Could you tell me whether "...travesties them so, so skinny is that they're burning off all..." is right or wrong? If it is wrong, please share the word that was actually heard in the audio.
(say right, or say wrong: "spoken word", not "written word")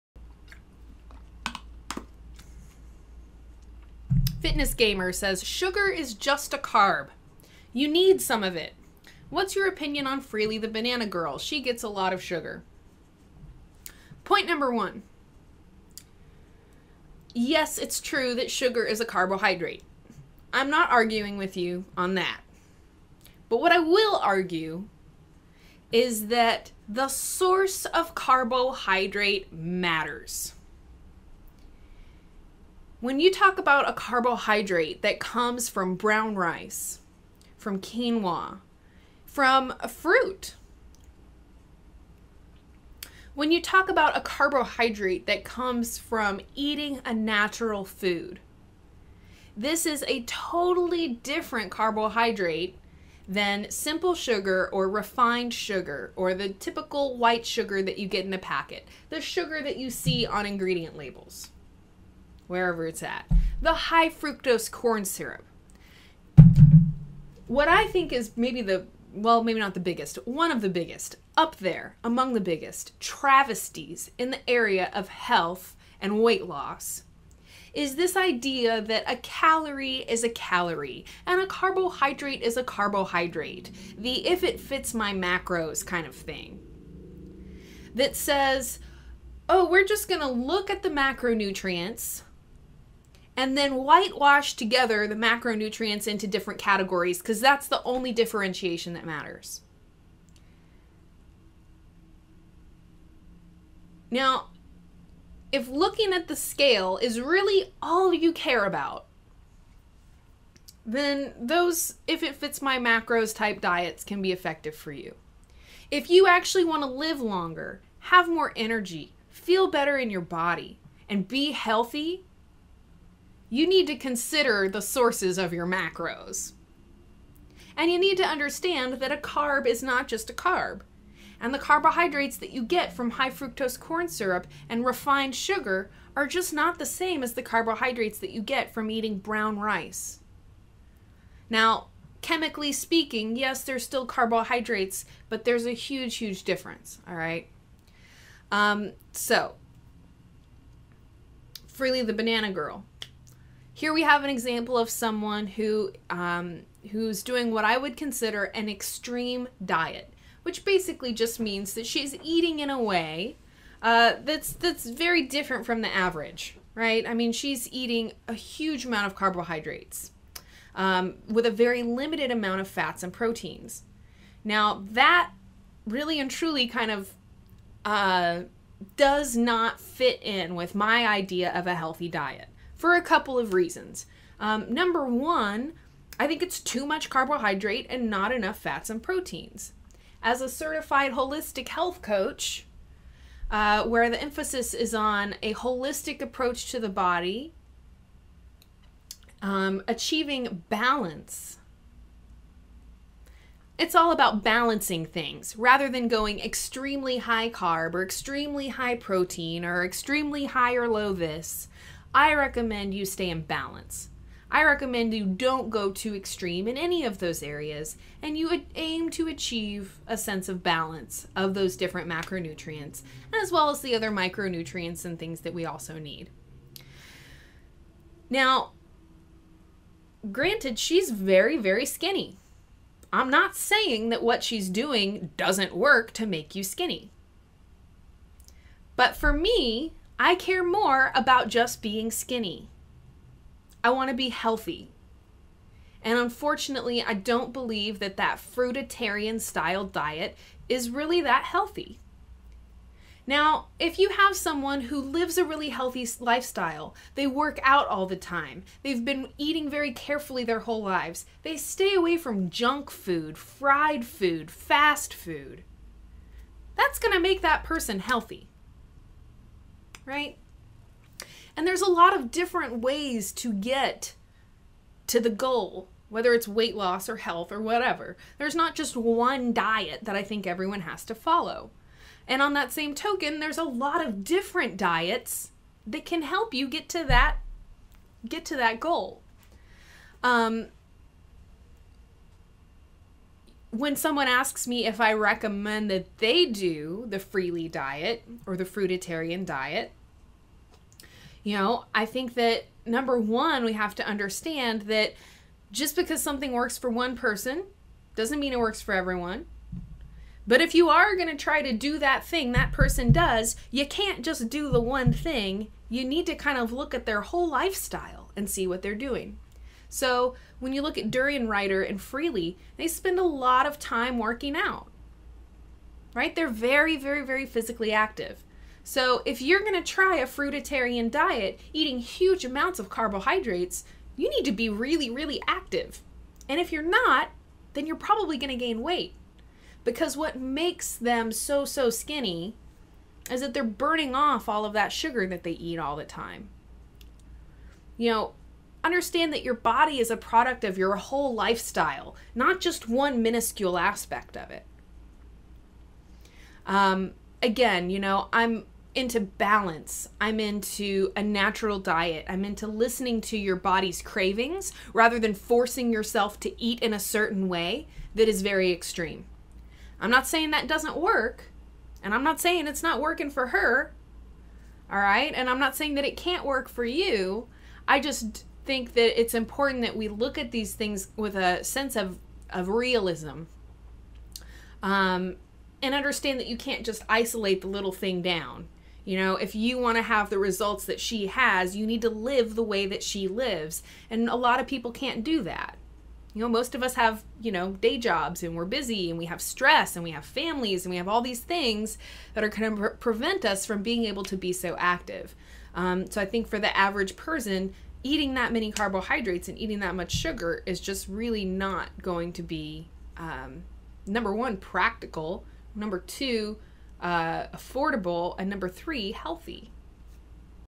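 wrong: "makes", not "travesties".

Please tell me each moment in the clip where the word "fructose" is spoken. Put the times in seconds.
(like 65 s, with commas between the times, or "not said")
64 s, 133 s.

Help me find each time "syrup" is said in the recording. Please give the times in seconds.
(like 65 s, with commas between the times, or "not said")
65 s, 134 s.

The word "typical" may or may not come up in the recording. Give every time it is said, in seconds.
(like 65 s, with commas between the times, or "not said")
56 s.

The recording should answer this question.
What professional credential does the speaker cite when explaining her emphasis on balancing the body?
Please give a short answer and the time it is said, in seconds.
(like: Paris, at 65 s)
certified holistic health coach, at 190 s.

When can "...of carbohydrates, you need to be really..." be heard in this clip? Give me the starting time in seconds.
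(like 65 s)
332 s.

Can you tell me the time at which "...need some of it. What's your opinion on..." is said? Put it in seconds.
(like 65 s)
7 s.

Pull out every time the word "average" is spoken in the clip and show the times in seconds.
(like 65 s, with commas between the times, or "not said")
165 s, 406 s.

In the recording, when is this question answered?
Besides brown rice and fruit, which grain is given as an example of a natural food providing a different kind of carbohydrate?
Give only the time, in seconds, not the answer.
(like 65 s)
37 s.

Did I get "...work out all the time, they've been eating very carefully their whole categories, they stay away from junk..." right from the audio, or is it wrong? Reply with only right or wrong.
wrong.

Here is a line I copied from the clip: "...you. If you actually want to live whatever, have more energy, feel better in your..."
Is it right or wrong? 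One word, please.
wrong.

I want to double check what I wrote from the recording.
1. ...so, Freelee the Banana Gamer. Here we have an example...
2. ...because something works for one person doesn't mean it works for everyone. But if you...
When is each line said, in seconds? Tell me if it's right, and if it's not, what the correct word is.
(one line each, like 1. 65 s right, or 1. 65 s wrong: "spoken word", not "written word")
1. 149 s wrong: "Girl", not "Gamer"
2. 305 s right.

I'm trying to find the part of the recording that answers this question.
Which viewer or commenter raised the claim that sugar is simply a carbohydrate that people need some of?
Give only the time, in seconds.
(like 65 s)
4 s.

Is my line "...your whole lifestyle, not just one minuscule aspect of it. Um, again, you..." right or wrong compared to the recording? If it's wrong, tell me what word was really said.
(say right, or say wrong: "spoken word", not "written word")
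right.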